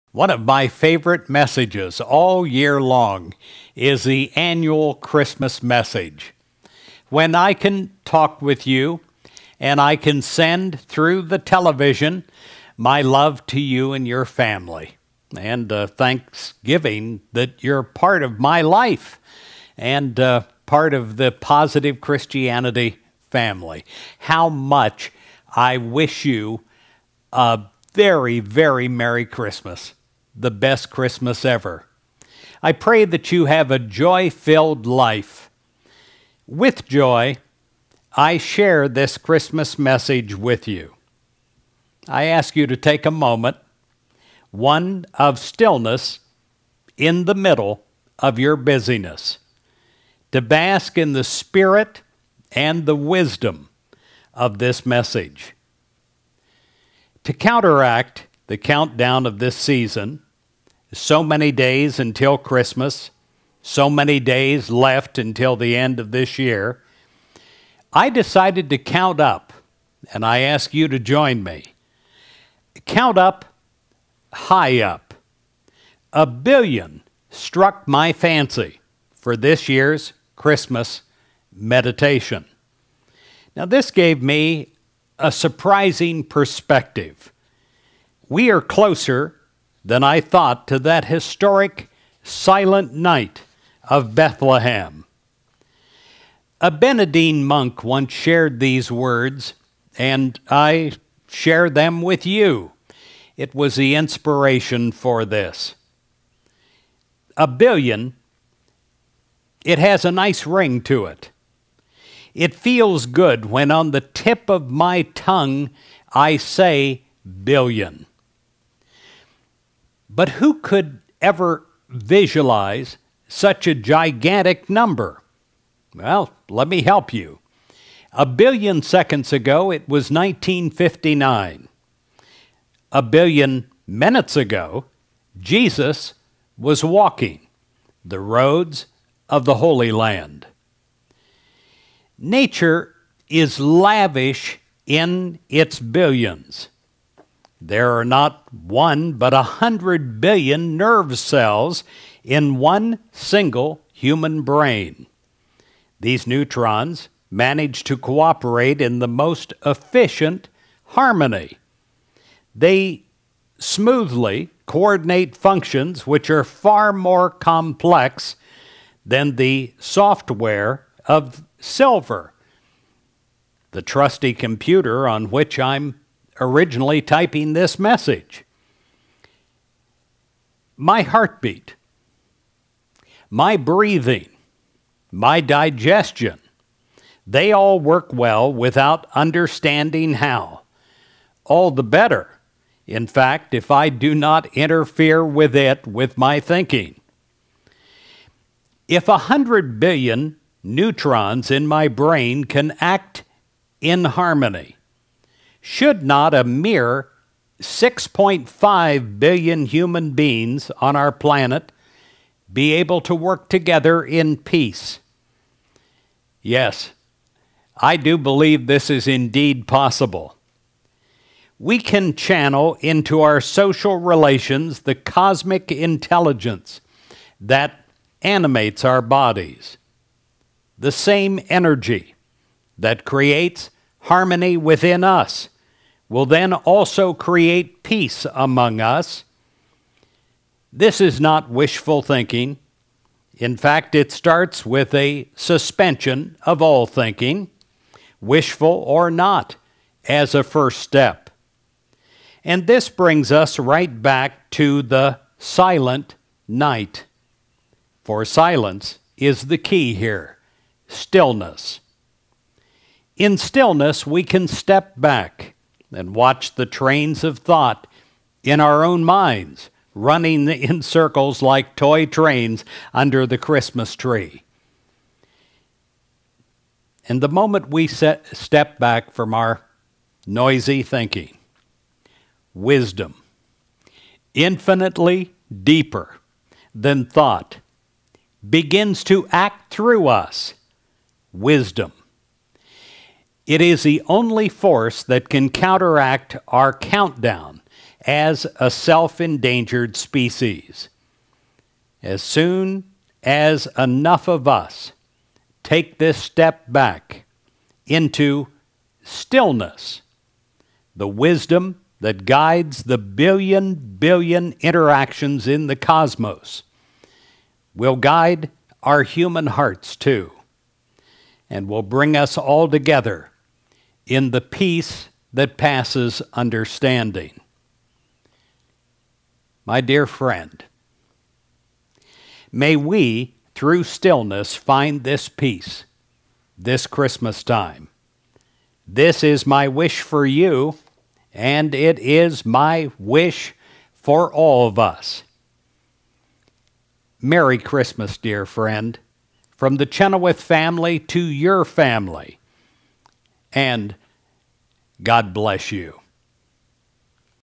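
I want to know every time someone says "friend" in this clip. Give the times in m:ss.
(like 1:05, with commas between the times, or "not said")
5:30, 5:48.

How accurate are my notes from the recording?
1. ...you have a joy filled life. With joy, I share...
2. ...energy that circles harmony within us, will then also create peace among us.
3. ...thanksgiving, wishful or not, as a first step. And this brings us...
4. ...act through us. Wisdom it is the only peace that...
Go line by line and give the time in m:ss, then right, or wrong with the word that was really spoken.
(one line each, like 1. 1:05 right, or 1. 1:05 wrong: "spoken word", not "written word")
1. 0:33 right
2. 3:51 wrong: "creates", not "circles"
3. 4:06 wrong: "thinking", not "thanksgiving"
4. 4:49 wrong: "force", not "peace".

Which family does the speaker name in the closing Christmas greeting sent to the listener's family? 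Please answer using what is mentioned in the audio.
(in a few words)
The Chenoweth family.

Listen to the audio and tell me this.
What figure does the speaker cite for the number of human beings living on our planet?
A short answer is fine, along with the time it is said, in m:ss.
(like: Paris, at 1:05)
6.5 billion, at 3:27.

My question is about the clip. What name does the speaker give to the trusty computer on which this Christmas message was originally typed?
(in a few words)
Silver.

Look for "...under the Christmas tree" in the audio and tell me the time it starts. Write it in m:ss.
4:32.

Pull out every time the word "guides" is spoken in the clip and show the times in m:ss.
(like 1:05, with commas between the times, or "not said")
5:12, 5:17.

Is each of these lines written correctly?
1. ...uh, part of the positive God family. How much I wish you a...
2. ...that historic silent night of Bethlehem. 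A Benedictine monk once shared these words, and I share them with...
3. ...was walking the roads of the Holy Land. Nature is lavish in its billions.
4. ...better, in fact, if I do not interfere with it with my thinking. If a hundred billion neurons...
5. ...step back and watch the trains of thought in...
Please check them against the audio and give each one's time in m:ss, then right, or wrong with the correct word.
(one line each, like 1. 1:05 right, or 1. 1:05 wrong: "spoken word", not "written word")
1. 0:20 wrong: "Christianity", not "God"
2. 1:30 right
3. 2:16 right
4. 3:11 right
5. 4:24 right.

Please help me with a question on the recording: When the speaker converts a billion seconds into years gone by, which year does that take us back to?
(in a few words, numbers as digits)
1959.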